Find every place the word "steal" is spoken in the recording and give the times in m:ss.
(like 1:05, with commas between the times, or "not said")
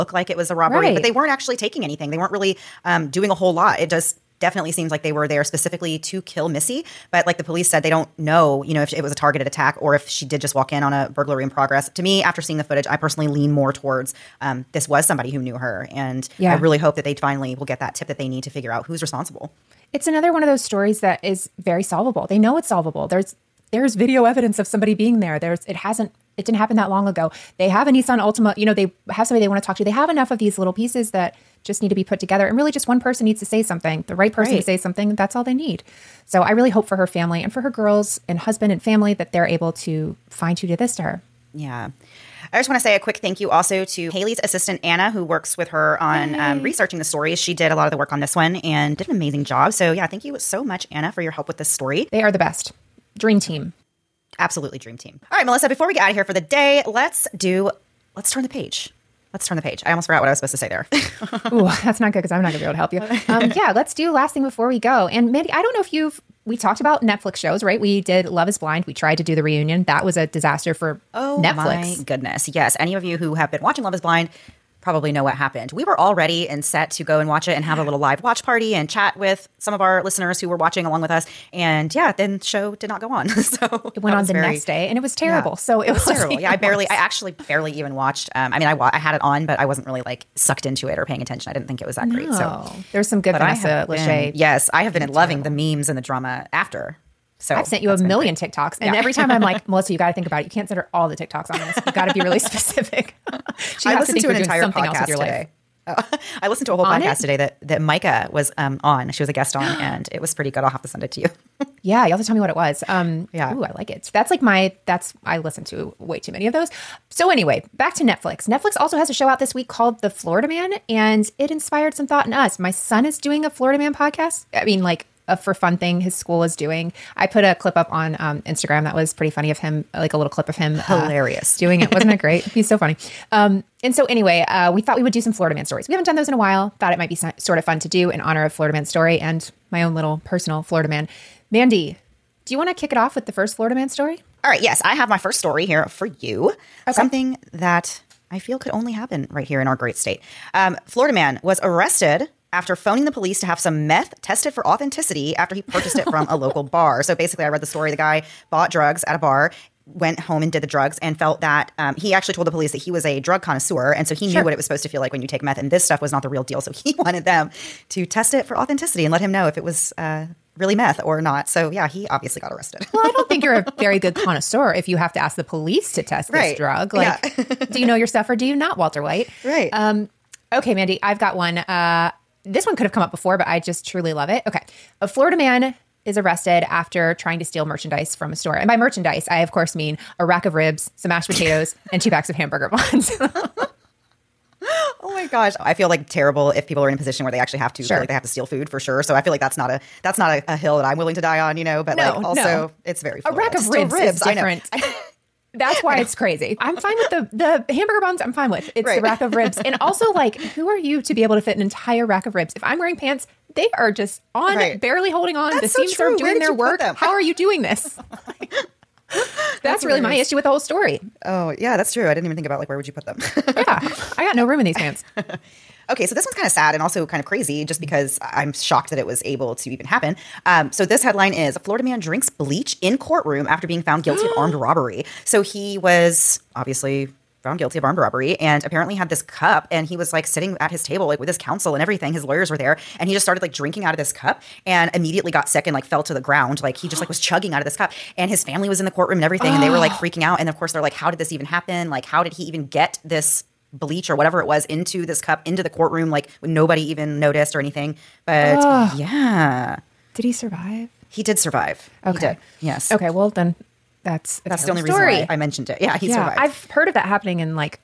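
3:07, 3:18.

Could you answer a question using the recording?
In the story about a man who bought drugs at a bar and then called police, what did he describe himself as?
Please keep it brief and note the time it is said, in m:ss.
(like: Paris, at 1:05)
drug connoisseur, at 2:43.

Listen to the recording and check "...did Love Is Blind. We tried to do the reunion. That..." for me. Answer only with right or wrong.
right.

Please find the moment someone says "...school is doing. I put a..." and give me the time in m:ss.
2:06.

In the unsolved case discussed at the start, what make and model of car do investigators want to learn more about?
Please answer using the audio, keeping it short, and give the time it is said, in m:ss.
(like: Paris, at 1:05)
Nissan Altima, at 0:27.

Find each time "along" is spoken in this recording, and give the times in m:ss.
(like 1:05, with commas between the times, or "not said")
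1:20.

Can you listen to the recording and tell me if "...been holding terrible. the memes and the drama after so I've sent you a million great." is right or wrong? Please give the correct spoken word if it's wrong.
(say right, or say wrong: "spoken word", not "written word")
wrong: "loving", not "holding".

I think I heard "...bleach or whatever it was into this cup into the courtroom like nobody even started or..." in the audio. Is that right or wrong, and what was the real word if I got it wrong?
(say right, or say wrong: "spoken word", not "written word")
wrong: "noticed", not "started".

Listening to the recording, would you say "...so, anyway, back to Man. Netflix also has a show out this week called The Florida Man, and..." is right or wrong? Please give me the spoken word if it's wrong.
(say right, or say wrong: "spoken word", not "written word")
wrong: "Netflix", not "Man".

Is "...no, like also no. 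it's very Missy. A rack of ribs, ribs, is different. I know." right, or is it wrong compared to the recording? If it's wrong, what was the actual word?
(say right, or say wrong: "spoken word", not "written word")
wrong: "Florida", not "Missy".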